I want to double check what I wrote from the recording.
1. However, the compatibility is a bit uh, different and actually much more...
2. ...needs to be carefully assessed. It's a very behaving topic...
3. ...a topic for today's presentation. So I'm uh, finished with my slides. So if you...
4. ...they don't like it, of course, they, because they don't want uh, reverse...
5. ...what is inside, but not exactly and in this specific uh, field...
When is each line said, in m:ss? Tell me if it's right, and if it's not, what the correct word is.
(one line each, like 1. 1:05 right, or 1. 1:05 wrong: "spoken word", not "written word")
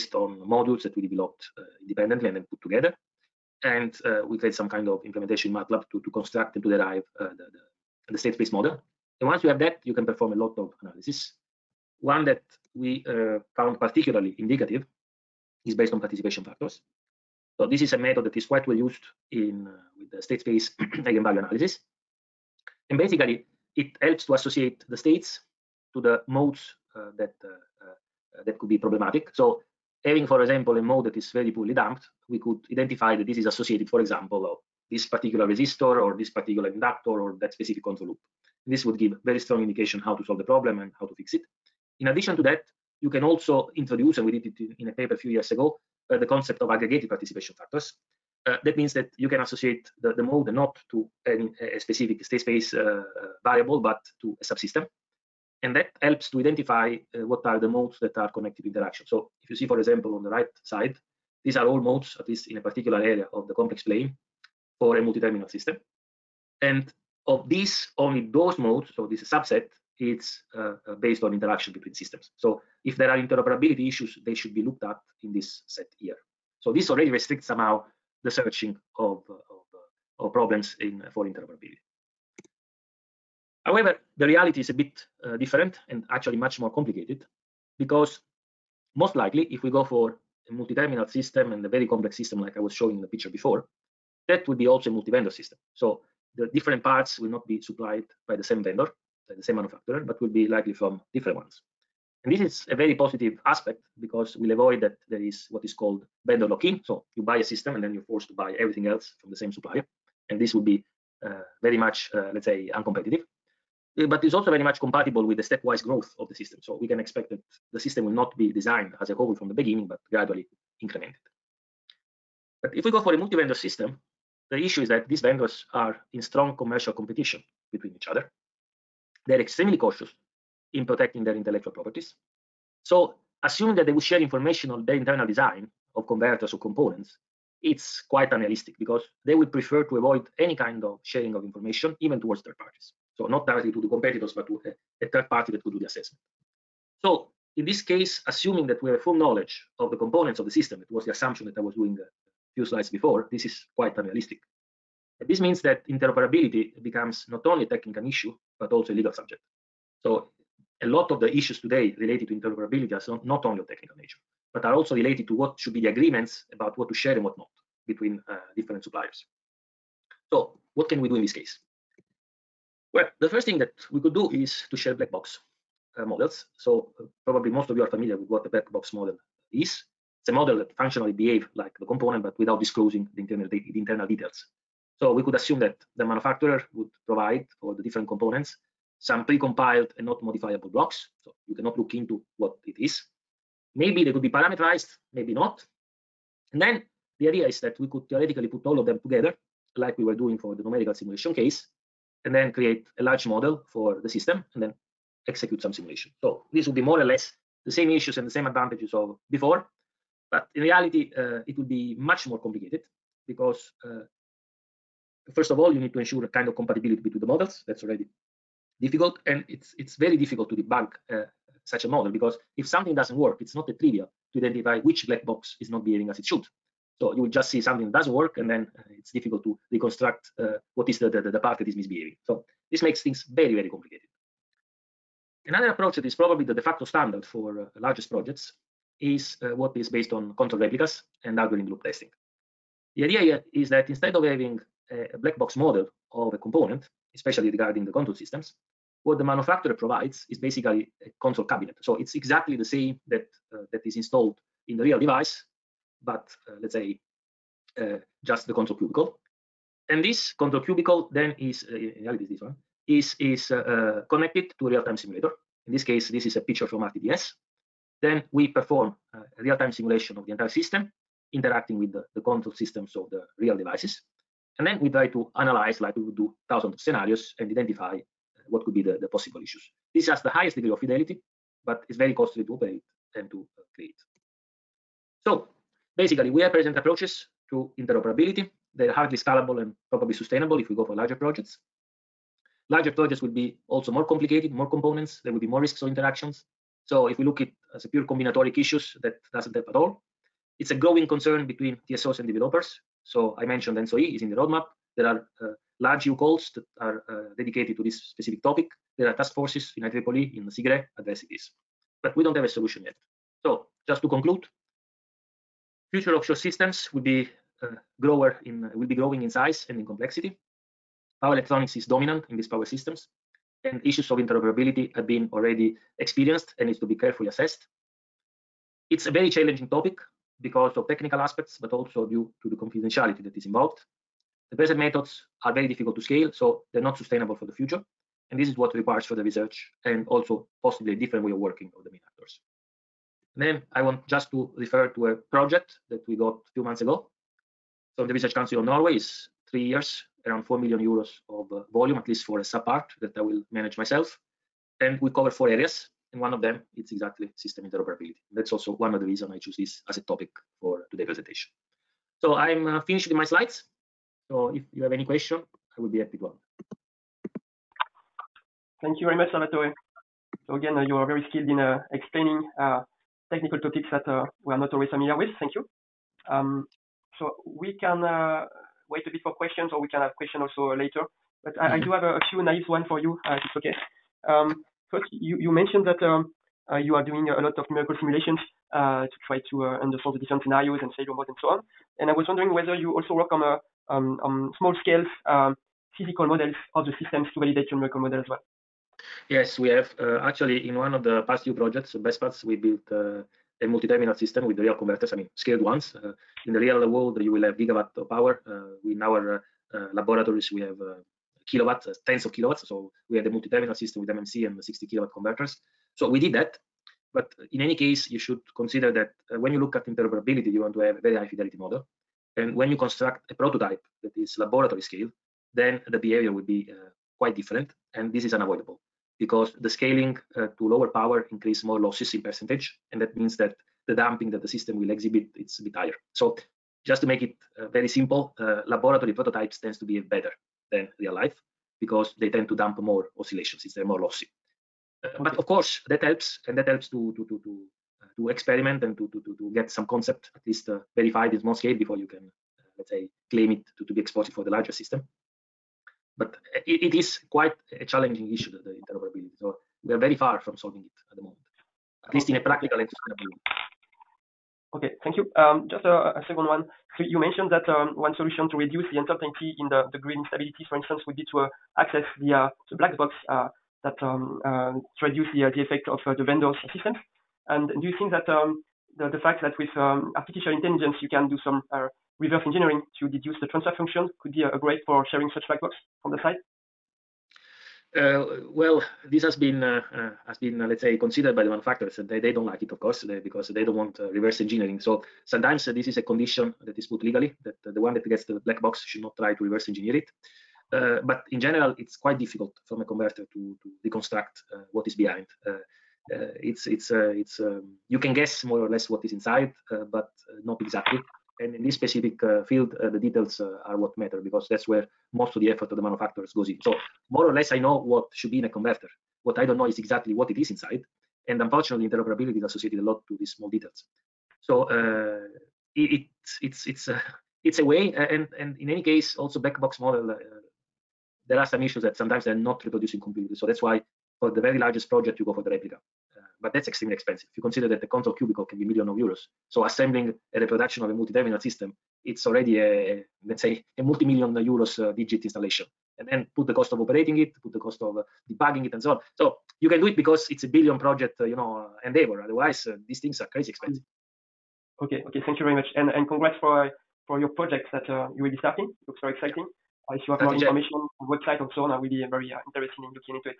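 1. 1:23 wrong: "reality", not "compatibility"
2. 5:26 wrong: "challenging", not "behaving"
3. 5:59 right
4. 8:12 right
5. 8:28 right.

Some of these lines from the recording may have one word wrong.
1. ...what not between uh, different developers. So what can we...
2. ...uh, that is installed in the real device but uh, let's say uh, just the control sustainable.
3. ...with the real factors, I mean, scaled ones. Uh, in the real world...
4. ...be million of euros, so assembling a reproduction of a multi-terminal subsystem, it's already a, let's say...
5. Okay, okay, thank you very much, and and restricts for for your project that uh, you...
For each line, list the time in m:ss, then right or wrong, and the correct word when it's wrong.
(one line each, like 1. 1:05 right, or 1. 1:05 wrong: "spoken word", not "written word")
1. 2:47 wrong: "suppliers", not "developers"
2. 4:13 wrong: "cubicle", not "sustainable"
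3. 6:44 wrong: "converters", not "factors"
4. 8:58 wrong: "system", not "subsystem"
5. 9:14 wrong: "congrats", not "restricts".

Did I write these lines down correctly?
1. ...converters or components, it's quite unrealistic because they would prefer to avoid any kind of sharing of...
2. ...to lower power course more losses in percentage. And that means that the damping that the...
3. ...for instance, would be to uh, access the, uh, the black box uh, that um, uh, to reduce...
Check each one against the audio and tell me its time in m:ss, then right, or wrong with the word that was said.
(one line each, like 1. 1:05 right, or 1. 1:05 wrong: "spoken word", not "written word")
1. 2:16 right
2. 7:10 wrong: "increase", not "course"
3. 7:50 right.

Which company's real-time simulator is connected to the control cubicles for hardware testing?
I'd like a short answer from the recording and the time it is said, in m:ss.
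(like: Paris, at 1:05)
RTDS, at 4:26.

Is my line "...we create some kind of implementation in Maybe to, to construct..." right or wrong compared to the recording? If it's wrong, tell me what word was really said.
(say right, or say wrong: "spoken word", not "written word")
wrong: "MATLAB", not "Maybe".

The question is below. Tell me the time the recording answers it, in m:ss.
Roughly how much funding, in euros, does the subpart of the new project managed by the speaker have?
5:50.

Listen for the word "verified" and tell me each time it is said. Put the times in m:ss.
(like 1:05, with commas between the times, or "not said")
7:30.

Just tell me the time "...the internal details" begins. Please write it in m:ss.
3:03.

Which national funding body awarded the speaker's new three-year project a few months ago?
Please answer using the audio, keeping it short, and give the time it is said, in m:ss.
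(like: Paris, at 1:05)
Research Council of Norway, at 5:48.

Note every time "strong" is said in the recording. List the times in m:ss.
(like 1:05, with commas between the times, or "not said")
0:39, 2:06.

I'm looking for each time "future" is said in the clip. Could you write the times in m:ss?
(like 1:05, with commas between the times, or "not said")
5:15, 5:37.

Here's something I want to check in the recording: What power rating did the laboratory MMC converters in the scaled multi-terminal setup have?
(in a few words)
60 kilowatts.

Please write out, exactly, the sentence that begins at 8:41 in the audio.
And unfortunately, interoperability is associated a lot to these small details.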